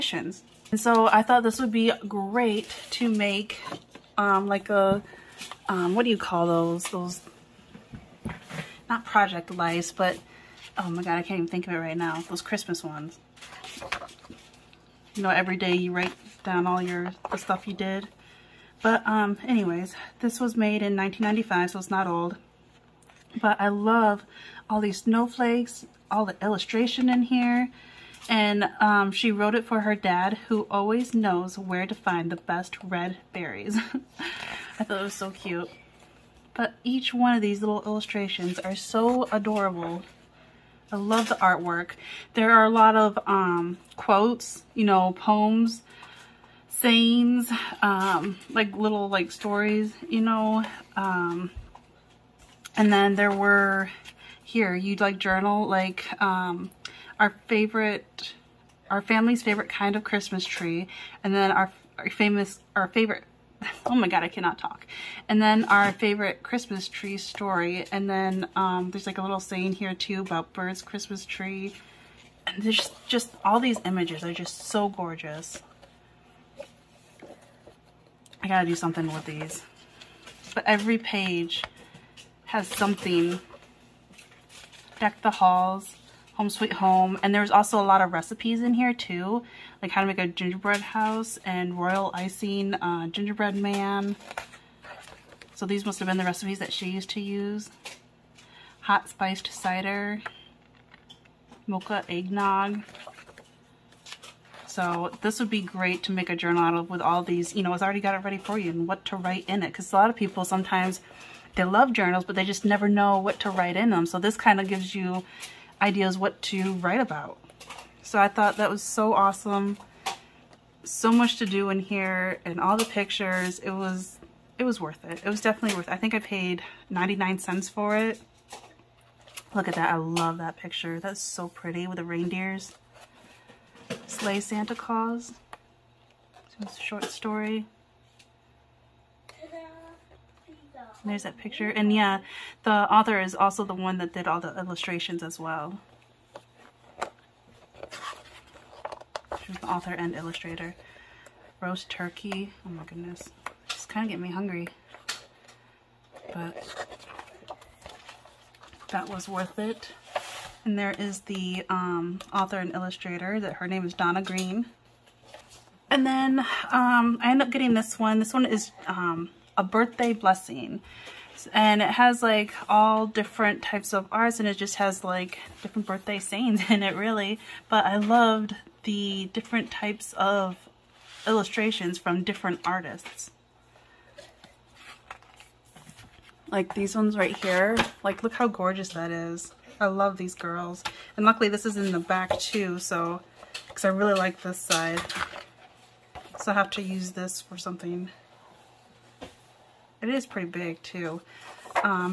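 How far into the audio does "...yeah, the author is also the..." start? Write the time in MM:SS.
02:21.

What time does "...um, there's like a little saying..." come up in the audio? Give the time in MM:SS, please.
01:08.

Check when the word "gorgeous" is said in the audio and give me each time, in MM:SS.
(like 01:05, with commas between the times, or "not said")
01:14, 03:08.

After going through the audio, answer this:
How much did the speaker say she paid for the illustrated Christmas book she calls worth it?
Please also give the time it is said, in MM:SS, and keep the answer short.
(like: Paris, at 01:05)
99 cents, at 02:06.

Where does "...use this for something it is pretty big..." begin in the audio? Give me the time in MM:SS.
03:16.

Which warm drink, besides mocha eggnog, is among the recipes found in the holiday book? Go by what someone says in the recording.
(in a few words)
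Hot spiced cider.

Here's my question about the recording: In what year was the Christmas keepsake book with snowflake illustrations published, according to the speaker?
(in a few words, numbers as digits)
1995.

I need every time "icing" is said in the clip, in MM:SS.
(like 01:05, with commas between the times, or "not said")
01:32.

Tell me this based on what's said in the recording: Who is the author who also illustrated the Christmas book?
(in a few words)
Donna Green.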